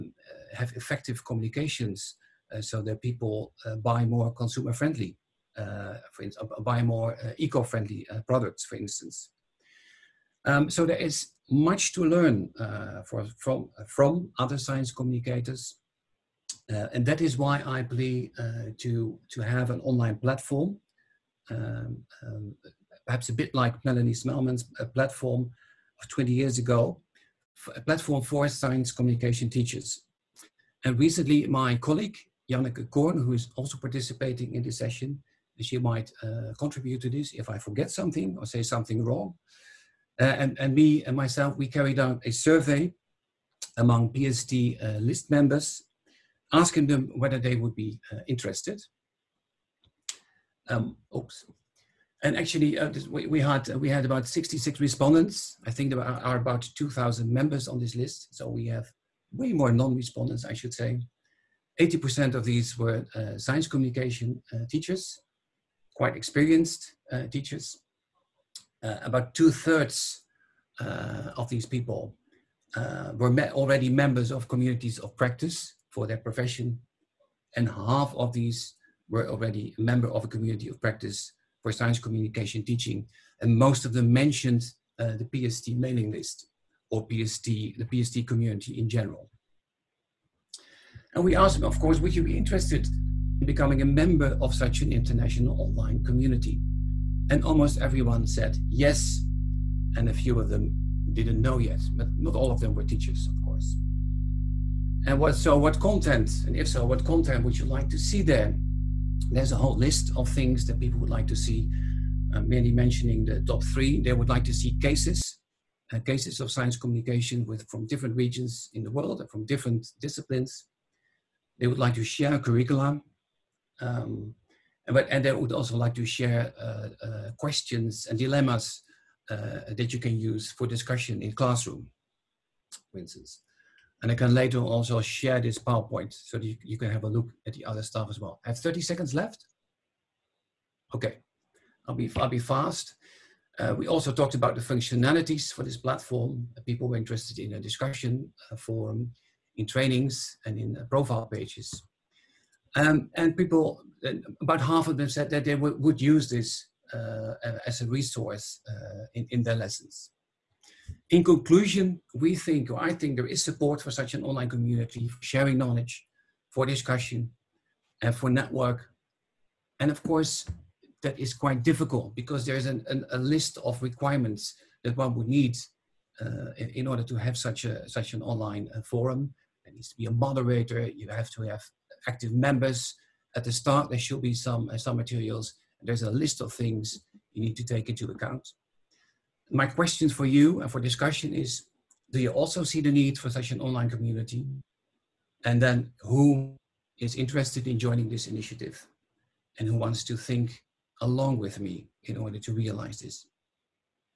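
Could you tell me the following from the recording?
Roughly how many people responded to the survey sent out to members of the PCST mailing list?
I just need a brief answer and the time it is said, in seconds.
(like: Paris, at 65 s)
66, at 54 s.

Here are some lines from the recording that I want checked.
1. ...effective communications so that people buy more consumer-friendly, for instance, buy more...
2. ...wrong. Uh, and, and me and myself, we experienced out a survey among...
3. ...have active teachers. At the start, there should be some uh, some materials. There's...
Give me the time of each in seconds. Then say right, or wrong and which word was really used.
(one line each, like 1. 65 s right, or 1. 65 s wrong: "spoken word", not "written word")
1. 0 s right
2. 39 s wrong: "carried", not "experienced"
3. 181 s wrong: "members", not "teachers".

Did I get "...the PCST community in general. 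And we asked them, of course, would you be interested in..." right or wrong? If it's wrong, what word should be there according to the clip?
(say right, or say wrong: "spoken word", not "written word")
right.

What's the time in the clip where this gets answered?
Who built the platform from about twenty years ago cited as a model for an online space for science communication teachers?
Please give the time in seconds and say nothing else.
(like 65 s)
23 s.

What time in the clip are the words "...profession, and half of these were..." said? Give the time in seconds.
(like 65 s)
76 s.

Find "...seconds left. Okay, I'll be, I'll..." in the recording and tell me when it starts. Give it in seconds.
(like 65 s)
138 s.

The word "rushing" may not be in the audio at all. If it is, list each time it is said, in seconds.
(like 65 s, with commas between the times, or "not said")
not said.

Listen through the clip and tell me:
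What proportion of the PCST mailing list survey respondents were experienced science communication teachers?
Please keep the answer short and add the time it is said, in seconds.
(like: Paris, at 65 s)
80%, at 61 s.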